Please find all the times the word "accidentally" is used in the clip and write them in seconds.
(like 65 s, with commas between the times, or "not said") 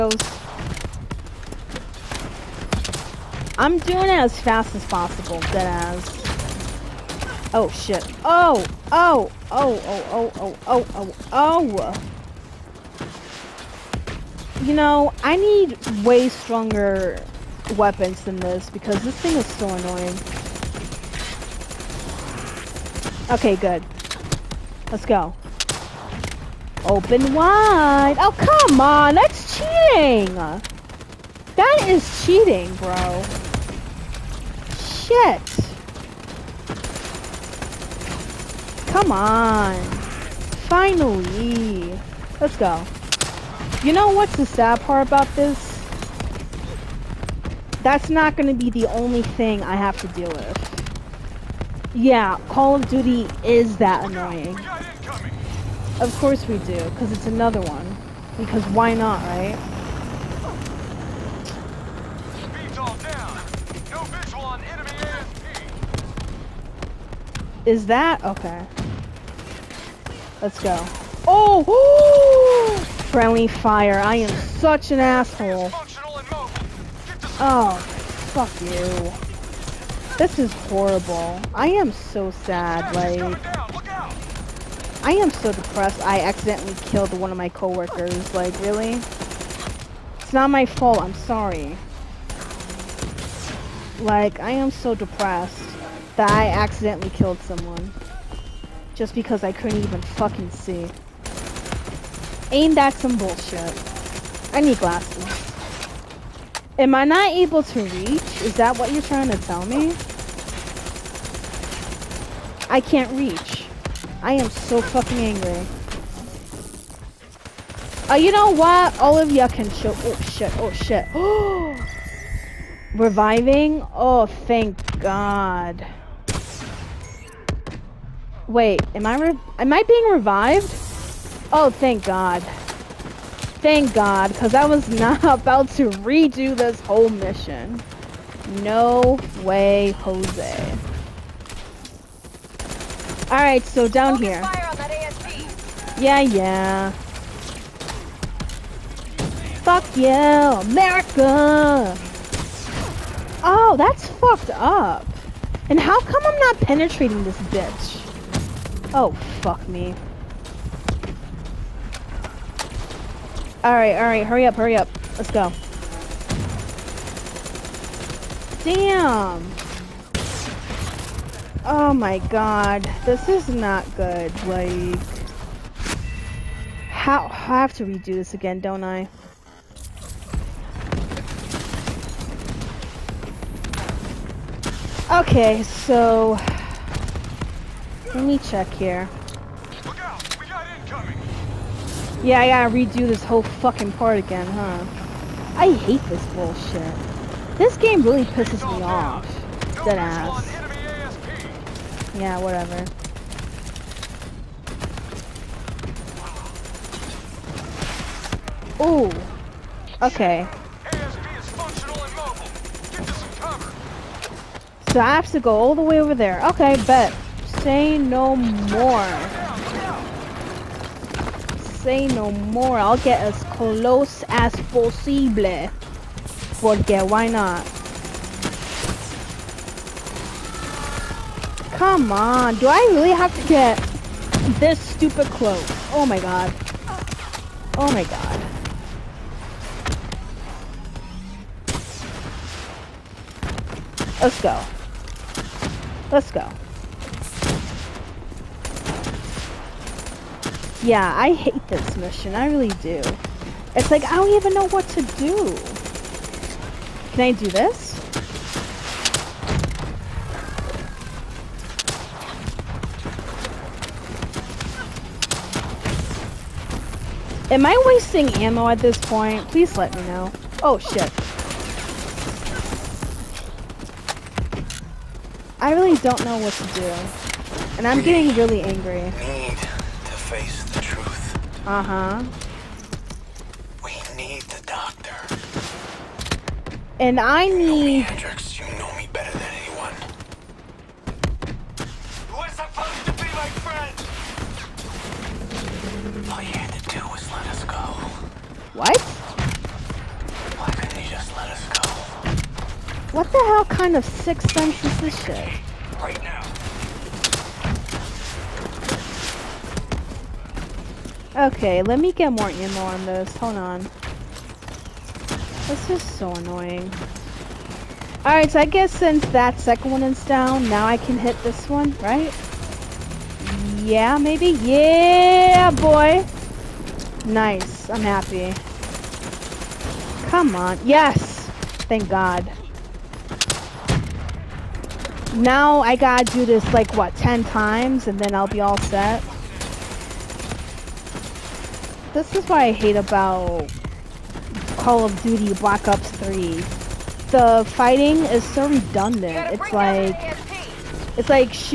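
86 s, 96 s.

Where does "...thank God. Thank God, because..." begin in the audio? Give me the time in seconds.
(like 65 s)
131 s.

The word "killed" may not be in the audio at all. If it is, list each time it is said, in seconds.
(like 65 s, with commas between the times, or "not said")
86 s, 97 s.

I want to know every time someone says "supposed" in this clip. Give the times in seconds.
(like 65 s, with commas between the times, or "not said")
292 s.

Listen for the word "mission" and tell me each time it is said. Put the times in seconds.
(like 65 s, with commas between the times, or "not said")
137 s, 251 s.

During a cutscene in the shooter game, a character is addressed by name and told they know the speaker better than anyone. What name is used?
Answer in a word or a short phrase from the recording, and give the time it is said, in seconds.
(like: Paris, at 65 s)
Hendricks, at 287 s.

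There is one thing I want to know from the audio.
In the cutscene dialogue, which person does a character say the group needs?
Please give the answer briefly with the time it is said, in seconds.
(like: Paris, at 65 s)
the doctor, at 284 s.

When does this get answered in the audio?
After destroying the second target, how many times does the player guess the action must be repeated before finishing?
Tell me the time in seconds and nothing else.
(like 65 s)
337 s.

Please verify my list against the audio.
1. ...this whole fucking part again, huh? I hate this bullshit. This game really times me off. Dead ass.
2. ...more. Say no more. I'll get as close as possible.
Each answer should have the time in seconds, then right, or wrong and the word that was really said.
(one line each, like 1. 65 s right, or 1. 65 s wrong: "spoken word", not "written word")
1. 193 s wrong: "pisses", not "times"
2. 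218 s right.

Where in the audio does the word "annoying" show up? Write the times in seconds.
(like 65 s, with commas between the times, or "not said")
19 s, 54 s, 316 s.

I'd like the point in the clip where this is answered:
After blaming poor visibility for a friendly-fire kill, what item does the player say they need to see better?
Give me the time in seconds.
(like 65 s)
104 s.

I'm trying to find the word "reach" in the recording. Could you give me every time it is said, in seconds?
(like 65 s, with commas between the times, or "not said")
107 s, 113 s.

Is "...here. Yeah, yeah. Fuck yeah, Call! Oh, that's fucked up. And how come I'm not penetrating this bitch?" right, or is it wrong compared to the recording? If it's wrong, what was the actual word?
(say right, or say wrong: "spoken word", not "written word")
wrong: "America", not "Call".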